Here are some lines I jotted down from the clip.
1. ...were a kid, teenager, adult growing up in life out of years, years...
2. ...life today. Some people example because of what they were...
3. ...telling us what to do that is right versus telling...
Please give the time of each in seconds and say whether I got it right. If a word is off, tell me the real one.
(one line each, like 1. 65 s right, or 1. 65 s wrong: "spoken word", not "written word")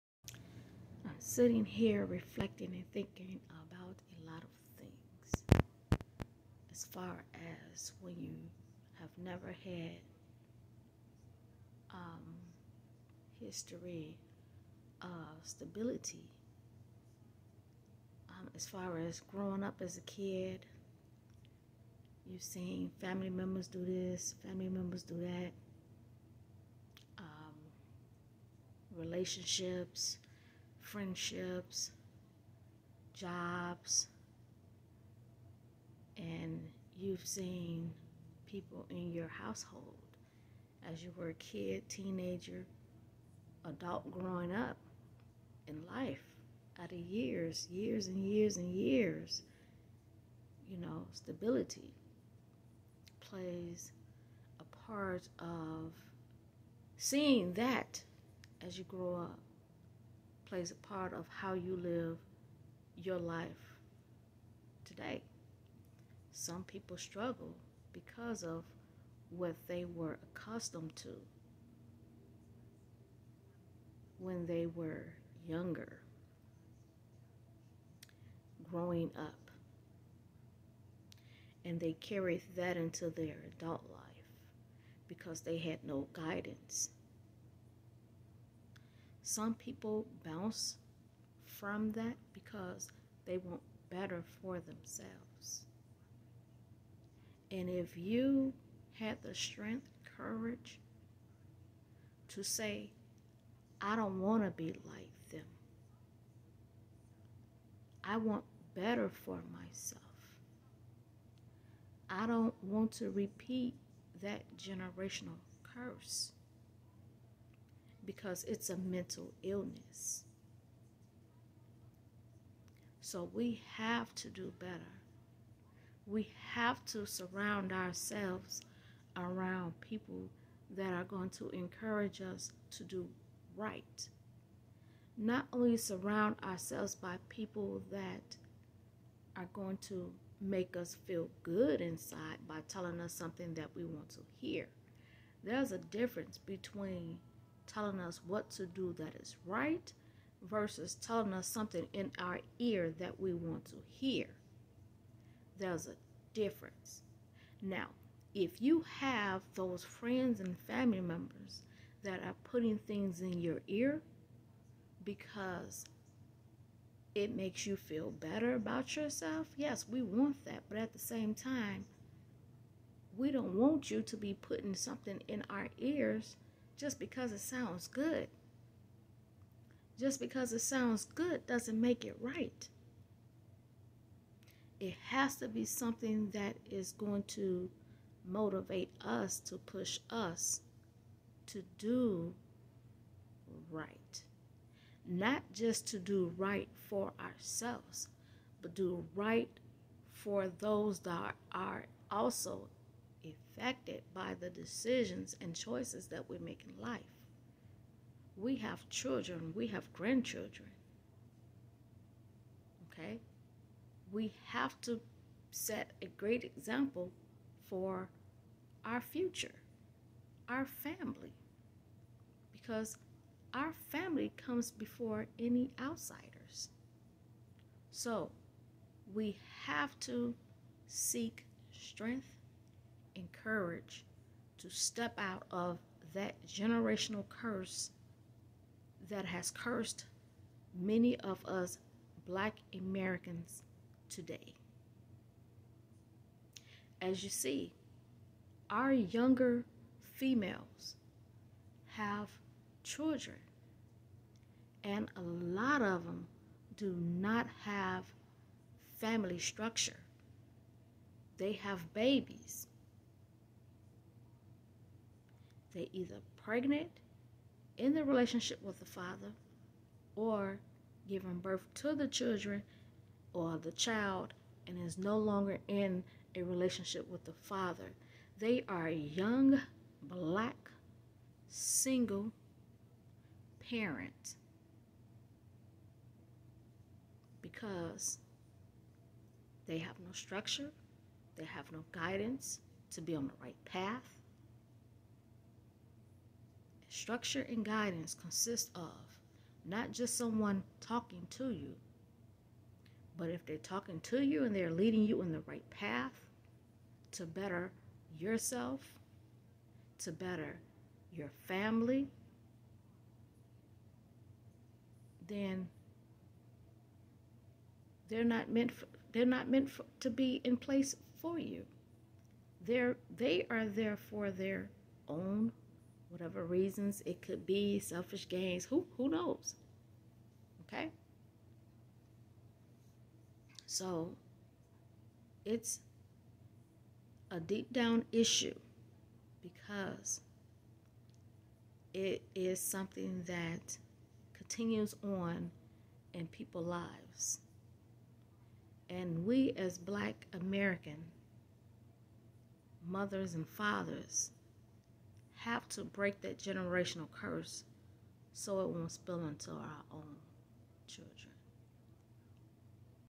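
1. 41 s right
2. 63 s wrong: "struggle", not "example"
3. 147 s right.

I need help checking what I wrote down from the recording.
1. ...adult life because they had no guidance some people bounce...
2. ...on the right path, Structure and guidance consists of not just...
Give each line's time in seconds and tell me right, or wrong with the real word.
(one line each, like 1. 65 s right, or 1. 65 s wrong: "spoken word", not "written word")
1. 83 s right
2. 293 s right.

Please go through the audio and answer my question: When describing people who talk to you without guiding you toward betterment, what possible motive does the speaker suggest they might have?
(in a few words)
selfish gains.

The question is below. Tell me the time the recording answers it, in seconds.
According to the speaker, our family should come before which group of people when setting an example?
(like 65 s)
225 s.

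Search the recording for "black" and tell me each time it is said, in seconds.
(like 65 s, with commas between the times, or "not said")
242 s, 280 s, 349 s.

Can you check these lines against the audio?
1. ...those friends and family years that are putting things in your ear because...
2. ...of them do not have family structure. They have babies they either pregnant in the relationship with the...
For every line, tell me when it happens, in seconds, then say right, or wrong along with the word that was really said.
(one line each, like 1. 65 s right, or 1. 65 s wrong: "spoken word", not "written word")
1. 159 s wrong: "members", not "years"
2. 255 s right.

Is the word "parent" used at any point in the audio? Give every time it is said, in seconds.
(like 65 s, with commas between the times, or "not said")
283 s.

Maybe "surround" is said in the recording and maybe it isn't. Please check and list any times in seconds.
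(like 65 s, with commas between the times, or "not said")
127 s, 135 s.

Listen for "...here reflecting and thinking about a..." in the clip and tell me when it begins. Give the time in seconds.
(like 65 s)
1 s.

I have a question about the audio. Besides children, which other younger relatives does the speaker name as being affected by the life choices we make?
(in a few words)
grandchildren.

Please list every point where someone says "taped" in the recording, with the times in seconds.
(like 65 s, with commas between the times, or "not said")
not said.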